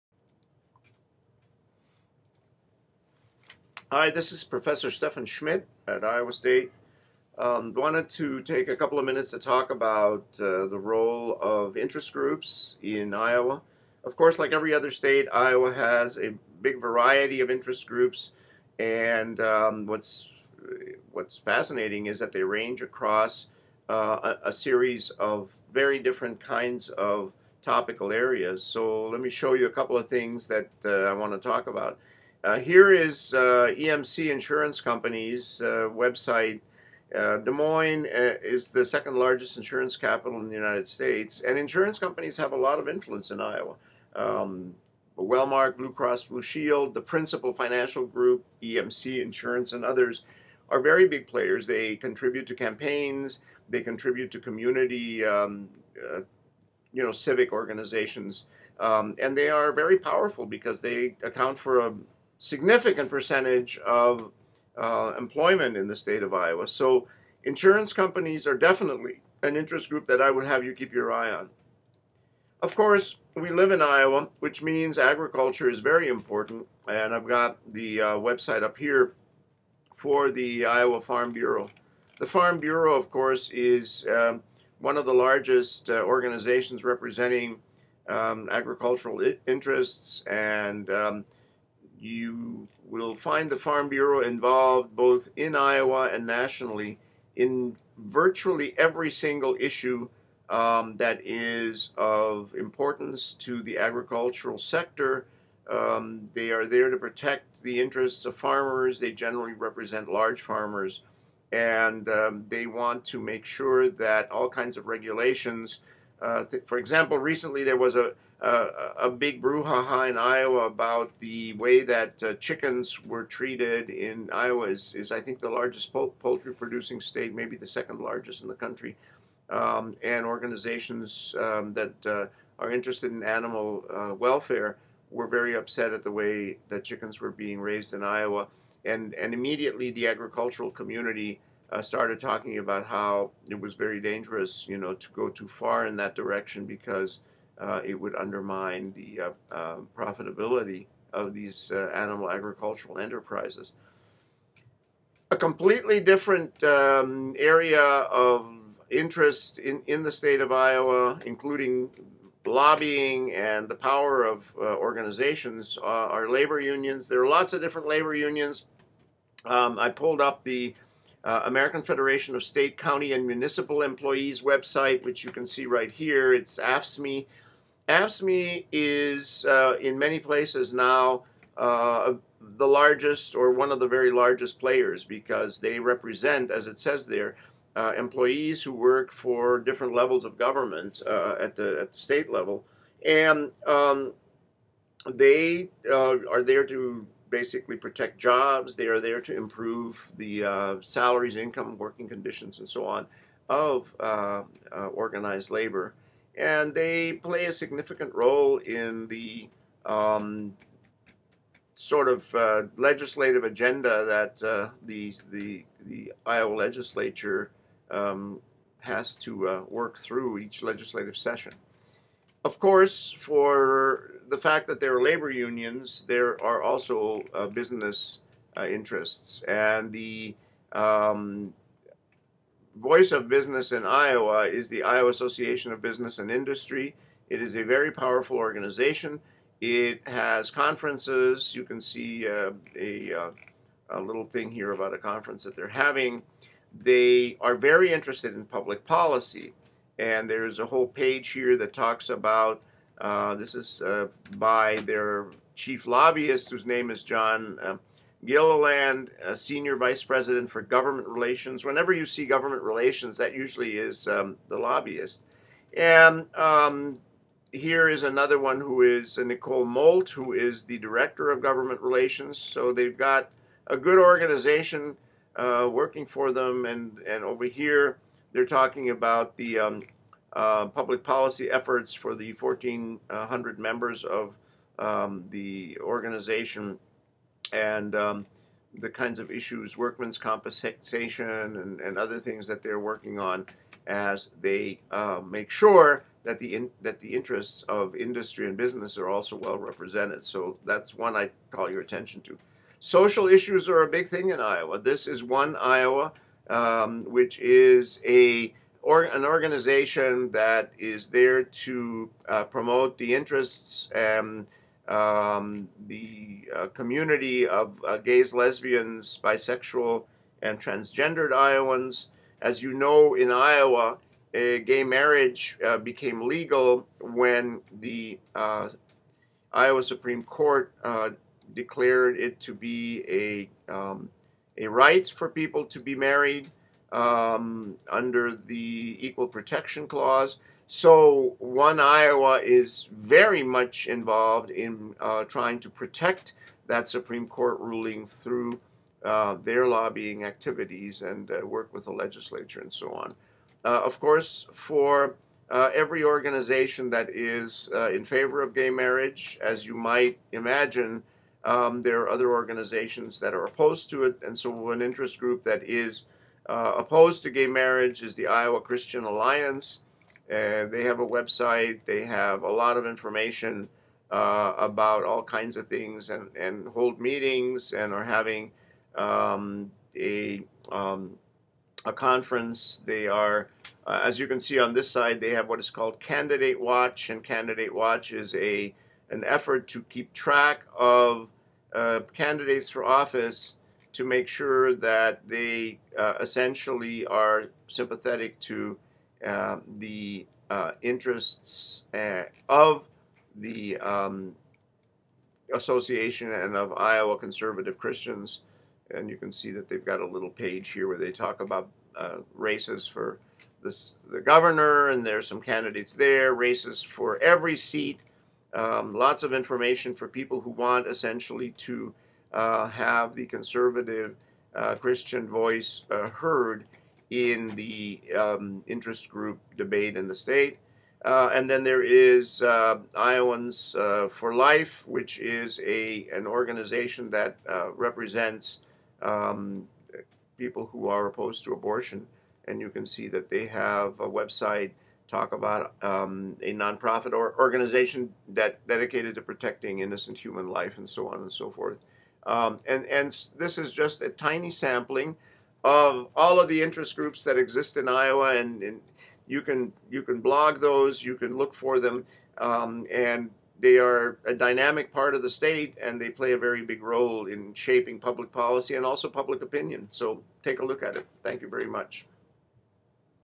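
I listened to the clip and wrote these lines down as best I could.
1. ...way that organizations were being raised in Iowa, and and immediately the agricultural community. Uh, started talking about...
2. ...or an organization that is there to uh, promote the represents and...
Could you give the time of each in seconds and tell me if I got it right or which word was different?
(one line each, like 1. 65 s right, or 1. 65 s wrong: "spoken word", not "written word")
1. 136 s wrong: "chickens", not "organizations"
2. 308 s wrong: "interests", not "represents".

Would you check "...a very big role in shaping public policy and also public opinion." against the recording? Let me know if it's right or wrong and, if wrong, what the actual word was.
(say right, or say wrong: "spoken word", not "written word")
right.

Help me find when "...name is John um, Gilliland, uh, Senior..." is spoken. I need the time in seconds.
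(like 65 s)
256 s.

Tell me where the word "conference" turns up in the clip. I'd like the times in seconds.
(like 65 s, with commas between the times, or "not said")
240 s, 244 s, 381 s.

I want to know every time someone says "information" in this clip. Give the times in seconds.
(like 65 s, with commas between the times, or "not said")
372 s, 419 s.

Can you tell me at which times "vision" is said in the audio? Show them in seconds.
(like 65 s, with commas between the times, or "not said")
not said.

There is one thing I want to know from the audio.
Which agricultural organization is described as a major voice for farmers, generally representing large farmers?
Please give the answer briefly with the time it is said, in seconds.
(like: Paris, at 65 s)
Iowa Farm Bureau, at 80 s.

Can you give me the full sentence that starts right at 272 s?
So they've got a good organization uh, working for them.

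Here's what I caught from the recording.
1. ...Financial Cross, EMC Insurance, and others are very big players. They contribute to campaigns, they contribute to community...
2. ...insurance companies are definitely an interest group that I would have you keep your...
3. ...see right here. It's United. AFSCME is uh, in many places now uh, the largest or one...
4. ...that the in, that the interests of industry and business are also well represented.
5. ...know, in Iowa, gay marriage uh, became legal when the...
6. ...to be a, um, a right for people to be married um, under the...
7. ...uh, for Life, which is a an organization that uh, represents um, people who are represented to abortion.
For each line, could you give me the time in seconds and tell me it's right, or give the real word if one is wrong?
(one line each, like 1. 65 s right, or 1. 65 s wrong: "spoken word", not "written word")
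1. 47 s wrong: "Group", not "Cross"
2. 67 s right
3. 175 s wrong: "AFSCME", not "United"
4. 296 s right
5. 322 s right
6. 332 s right
7. 433 s wrong: "opposed", not "represented".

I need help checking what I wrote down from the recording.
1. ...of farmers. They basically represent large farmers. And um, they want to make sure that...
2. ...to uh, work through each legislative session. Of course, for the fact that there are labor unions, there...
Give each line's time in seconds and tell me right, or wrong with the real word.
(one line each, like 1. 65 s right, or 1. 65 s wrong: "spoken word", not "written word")
1. 108 s wrong: "generally", not "basically"
2. 219 s right.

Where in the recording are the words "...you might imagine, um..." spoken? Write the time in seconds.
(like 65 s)
359 s.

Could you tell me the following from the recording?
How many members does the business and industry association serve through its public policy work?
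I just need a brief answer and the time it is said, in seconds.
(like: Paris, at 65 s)
1,400, at 282 s.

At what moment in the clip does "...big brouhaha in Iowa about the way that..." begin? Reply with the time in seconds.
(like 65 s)
119 s.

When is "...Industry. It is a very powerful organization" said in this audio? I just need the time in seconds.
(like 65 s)
236 s.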